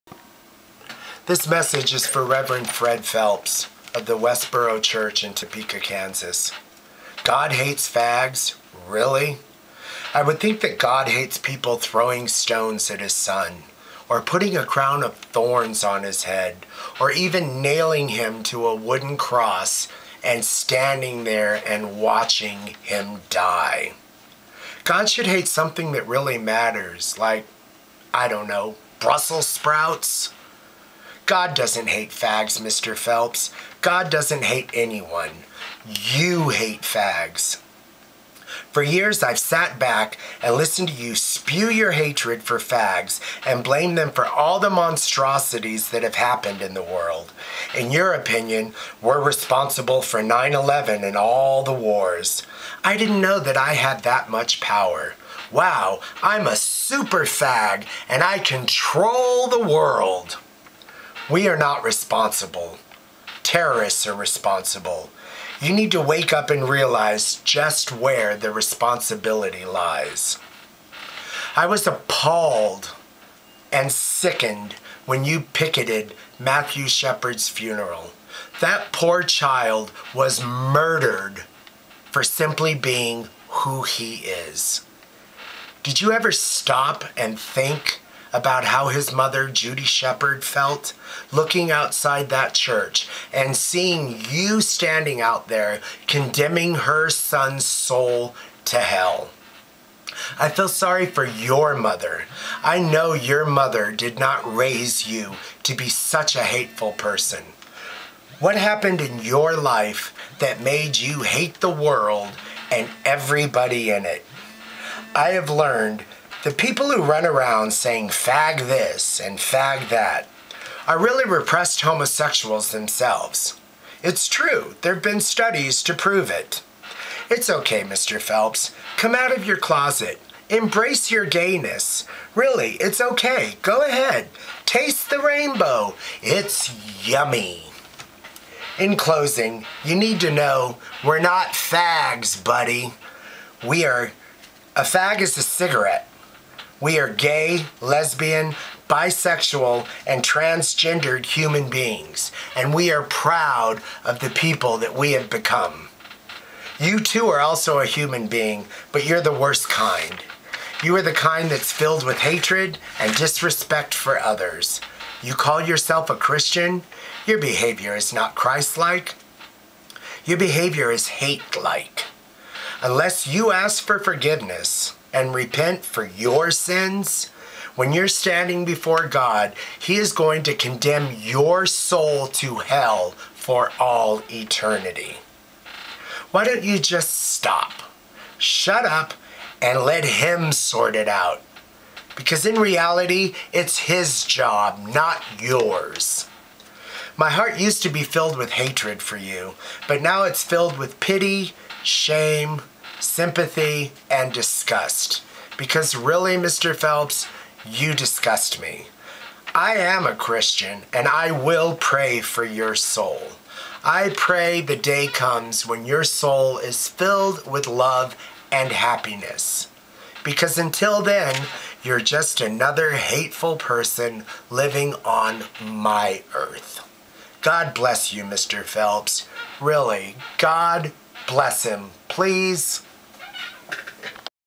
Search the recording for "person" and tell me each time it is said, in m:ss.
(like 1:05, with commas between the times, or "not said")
1:46, 3:43.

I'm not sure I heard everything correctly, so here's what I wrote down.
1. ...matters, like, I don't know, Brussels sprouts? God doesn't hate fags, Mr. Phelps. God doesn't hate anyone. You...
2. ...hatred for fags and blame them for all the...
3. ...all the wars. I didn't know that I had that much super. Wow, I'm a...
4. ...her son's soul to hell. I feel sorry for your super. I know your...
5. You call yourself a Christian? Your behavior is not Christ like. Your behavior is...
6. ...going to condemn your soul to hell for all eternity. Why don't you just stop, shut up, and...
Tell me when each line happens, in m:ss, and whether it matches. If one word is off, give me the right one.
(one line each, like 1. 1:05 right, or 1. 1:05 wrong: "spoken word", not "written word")
1. 0:26 right
2. 0:41 right
3. 0:51 wrong: "power", not "super"
4. 1:36 wrong: "mother", not "super"
5. 2:45 right
6. 3:00 right.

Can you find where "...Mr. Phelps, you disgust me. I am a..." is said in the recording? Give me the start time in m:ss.
3:26.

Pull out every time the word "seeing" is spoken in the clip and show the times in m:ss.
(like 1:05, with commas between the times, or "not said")
1:33.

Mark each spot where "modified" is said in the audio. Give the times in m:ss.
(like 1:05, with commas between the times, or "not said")
not said.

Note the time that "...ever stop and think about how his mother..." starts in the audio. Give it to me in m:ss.
1:26.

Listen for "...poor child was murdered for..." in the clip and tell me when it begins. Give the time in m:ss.
1:18.